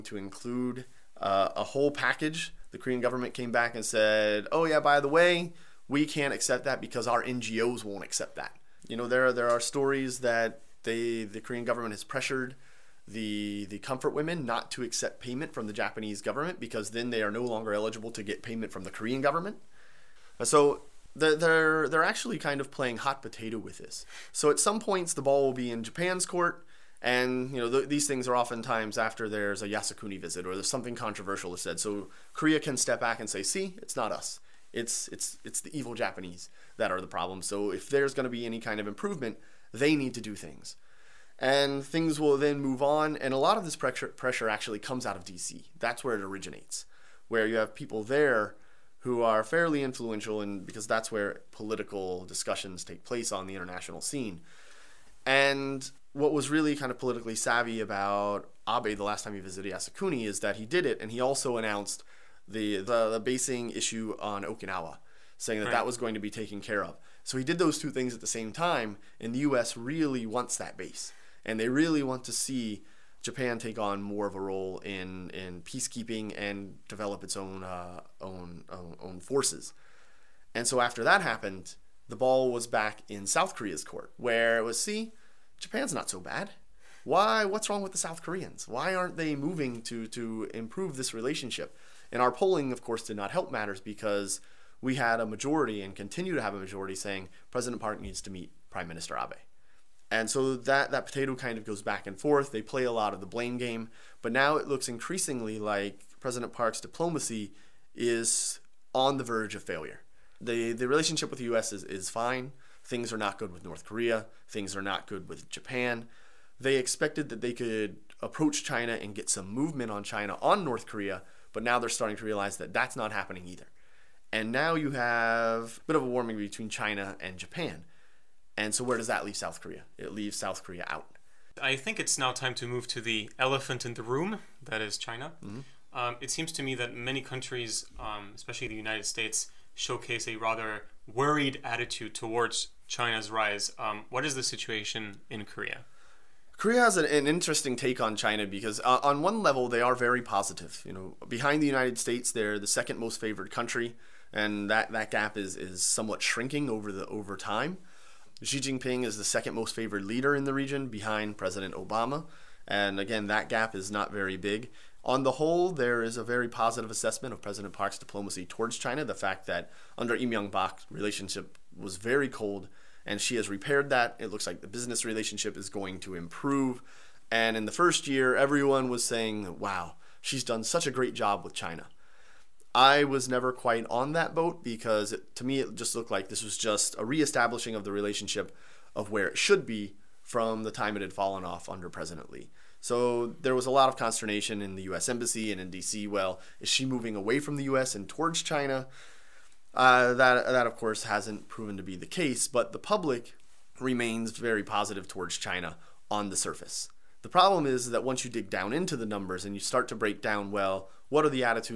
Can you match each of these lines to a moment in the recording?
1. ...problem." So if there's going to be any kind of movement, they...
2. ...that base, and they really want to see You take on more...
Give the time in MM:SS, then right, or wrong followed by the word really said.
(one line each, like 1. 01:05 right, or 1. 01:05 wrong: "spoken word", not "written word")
1. 00:37 wrong: "improvement", not "movement"
2. 01:10 wrong: "Japan", not "You".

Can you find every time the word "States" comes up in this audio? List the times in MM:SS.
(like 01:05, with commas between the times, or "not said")
02:19, 02:31.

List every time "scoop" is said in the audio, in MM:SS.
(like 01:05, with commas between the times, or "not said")
not said.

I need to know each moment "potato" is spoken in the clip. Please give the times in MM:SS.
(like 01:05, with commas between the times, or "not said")
00:23, 01:41.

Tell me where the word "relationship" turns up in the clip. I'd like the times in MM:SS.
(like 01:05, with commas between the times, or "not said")
01:31, 01:50, 02:50, 02:55, 03:07.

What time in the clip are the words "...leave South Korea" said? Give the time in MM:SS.
02:09.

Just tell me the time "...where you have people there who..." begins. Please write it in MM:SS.
00:47.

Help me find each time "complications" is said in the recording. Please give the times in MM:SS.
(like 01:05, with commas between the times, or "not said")
not said.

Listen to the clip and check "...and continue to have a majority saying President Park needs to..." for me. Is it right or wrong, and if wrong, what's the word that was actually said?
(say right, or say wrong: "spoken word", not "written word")
right.